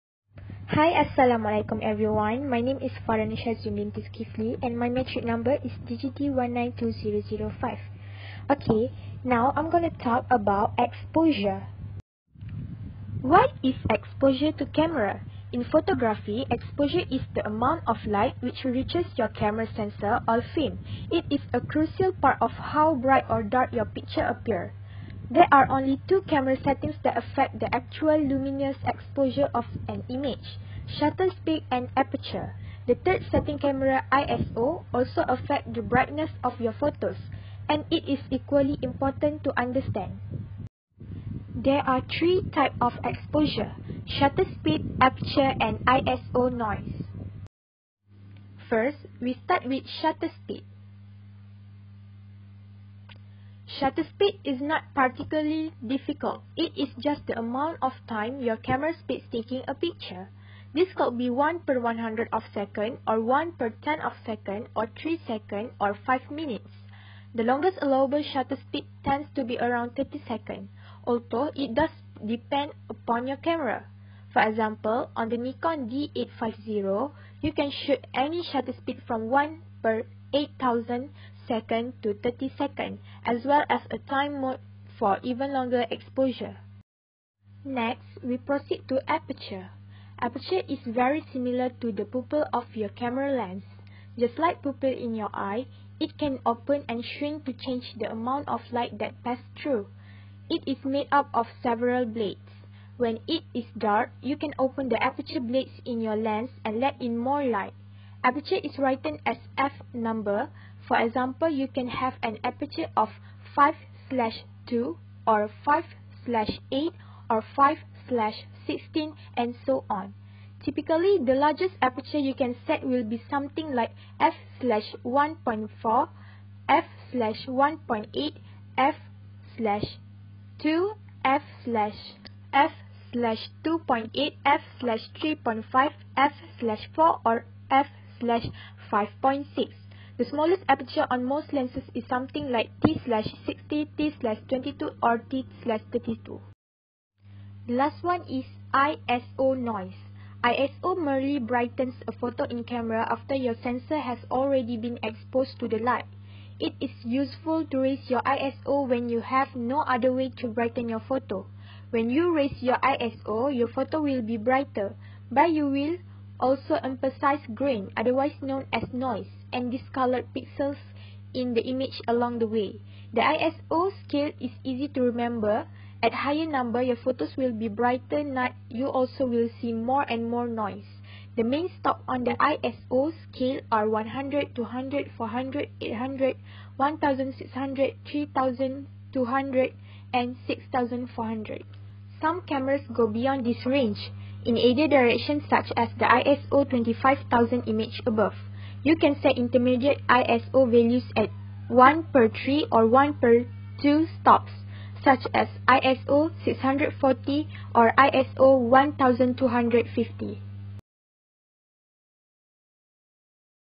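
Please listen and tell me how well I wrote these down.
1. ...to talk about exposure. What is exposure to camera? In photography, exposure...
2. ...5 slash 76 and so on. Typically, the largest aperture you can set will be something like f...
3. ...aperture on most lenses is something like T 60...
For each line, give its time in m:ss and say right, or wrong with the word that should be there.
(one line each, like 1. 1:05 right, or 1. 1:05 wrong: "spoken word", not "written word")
1. 0:09 right
2. 1:57 wrong: "16", not "76"
3. 2:20 right.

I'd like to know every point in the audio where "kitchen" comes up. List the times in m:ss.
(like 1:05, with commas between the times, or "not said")
not said.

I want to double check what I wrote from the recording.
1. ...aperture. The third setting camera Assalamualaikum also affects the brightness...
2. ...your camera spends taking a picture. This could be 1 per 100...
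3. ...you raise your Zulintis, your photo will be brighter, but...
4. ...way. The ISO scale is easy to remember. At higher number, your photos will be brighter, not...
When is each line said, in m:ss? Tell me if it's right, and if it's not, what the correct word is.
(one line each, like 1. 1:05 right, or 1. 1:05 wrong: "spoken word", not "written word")
1. 0:31 wrong: "ISO", not "Assalamualaikum"
2. 0:58 right
3. 2:42 wrong: "ISO", not "Zulintis"
4. 2:52 right.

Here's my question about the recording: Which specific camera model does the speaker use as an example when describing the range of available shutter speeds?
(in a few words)
Nikon D850.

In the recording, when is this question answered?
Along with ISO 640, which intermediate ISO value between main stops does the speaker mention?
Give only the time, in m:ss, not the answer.
3:27.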